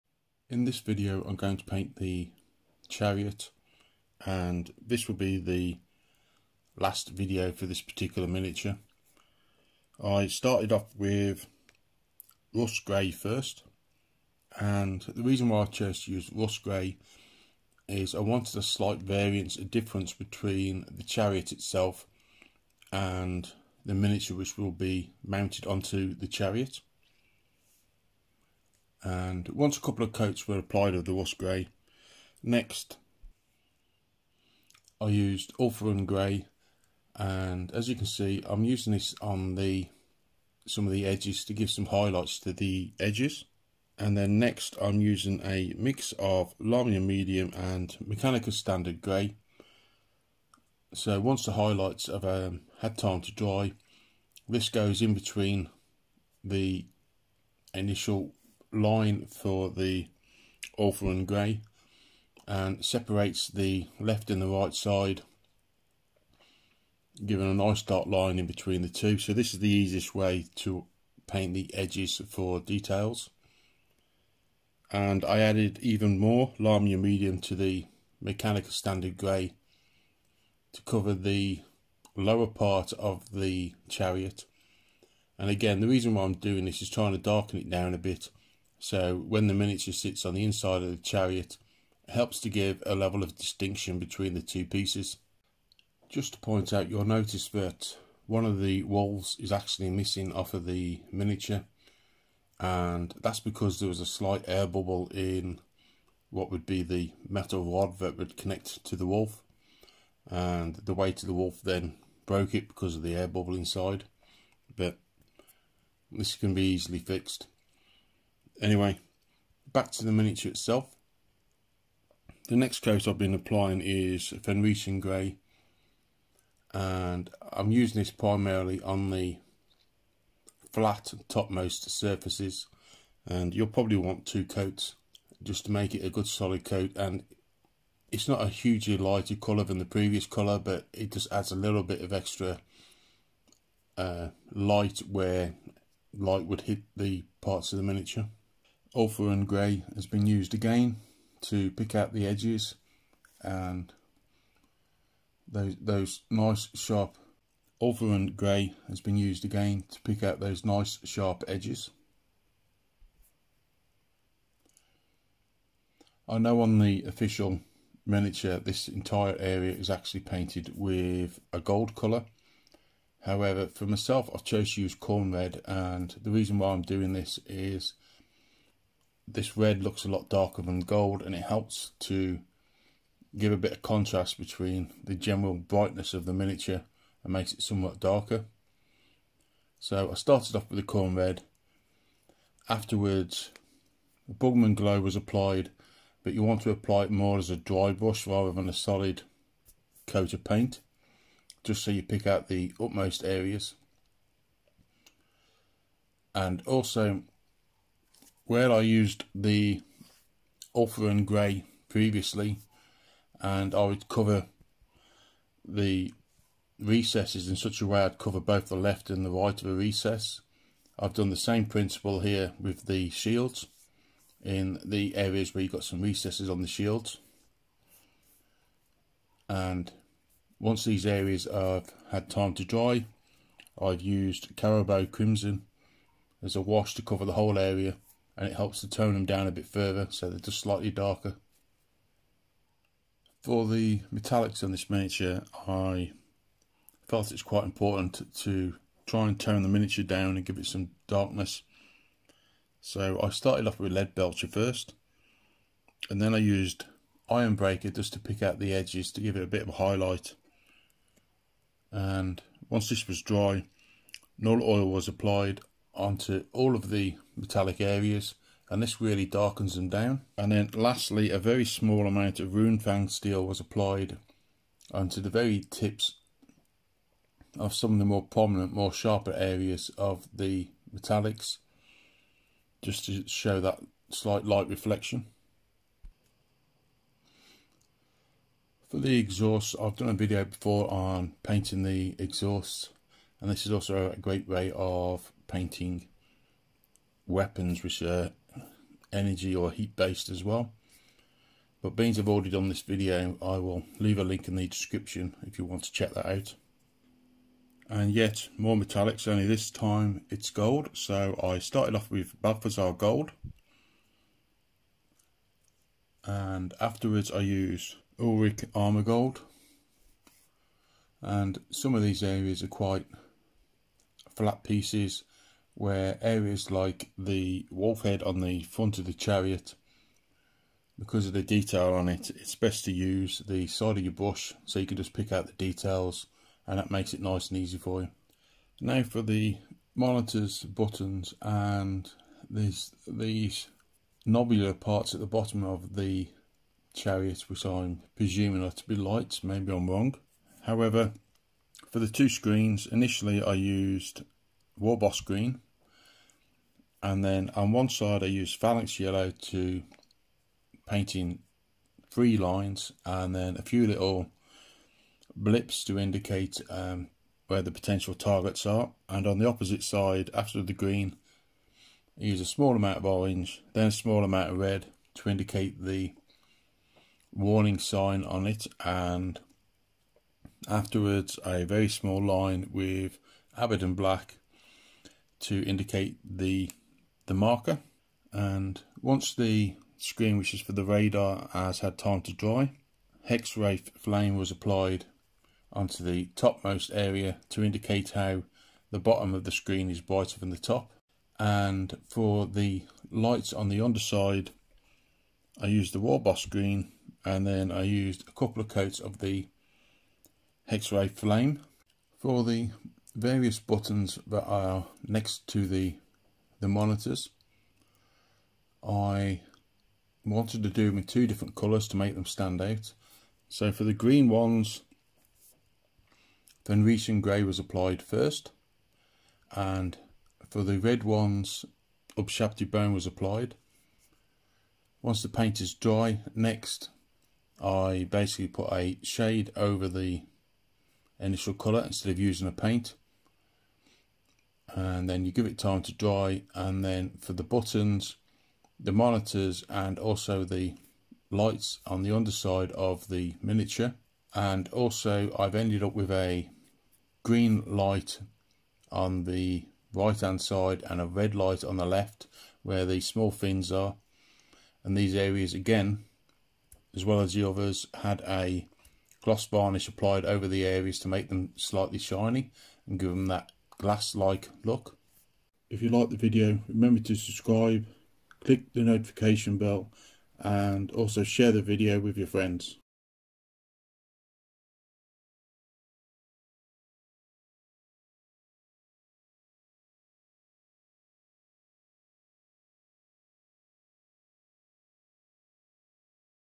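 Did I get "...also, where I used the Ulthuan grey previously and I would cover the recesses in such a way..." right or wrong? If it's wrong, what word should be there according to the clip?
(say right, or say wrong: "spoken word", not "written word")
right.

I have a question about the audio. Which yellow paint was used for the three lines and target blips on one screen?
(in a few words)
Phalanx yellow.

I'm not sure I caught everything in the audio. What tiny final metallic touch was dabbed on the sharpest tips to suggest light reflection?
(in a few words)
Runefang steel.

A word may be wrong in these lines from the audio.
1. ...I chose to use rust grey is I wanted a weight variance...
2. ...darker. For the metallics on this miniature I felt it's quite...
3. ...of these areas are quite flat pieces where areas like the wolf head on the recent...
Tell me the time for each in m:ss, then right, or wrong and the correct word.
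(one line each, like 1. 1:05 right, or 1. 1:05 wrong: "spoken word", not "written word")
1. 0:15 wrong: "slight", not "weight"
2. 4:00 right
3. 5:21 wrong: "front", not "recent".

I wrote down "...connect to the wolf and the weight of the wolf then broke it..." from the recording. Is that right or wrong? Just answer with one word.
right.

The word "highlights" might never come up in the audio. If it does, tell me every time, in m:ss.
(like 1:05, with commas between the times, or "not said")
0:41, 0:51, 4:19.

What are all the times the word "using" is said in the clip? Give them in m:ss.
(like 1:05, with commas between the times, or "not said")
0:38, 0:45, 2:07, 7:22.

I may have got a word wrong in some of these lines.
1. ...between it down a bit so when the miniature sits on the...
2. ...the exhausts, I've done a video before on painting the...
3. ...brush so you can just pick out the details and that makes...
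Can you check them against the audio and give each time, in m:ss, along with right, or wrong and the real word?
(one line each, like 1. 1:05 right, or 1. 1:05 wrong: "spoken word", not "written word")
1. 1:27 wrong: "darken", not "between"
2. 4:48 right
3. 5:34 right.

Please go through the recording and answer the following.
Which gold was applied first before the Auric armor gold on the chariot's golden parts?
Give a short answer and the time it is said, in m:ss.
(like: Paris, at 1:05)
Balthasar gold, at 5:12.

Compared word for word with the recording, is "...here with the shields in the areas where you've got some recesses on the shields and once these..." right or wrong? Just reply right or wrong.
right.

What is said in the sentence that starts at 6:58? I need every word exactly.
I wanted to do them in two different colours to make them stand out.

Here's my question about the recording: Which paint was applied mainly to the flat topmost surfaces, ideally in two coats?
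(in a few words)
Fenrisian Grey.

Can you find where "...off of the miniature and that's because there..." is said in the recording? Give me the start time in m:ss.
1:40.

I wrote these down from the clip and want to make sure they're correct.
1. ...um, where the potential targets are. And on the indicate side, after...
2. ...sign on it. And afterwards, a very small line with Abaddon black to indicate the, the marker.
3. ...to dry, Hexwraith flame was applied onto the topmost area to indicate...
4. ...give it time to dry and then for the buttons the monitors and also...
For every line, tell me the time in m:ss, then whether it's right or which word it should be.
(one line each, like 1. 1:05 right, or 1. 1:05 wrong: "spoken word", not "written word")
1. 6:06 wrong: "opposite", not "indicate"
2. 6:17 right
3. 6:32 right
4. 7:25 right.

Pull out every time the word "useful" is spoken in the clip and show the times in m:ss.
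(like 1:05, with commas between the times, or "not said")
not said.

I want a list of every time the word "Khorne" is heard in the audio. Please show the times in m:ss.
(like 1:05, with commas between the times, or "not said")
2:54, 3:10.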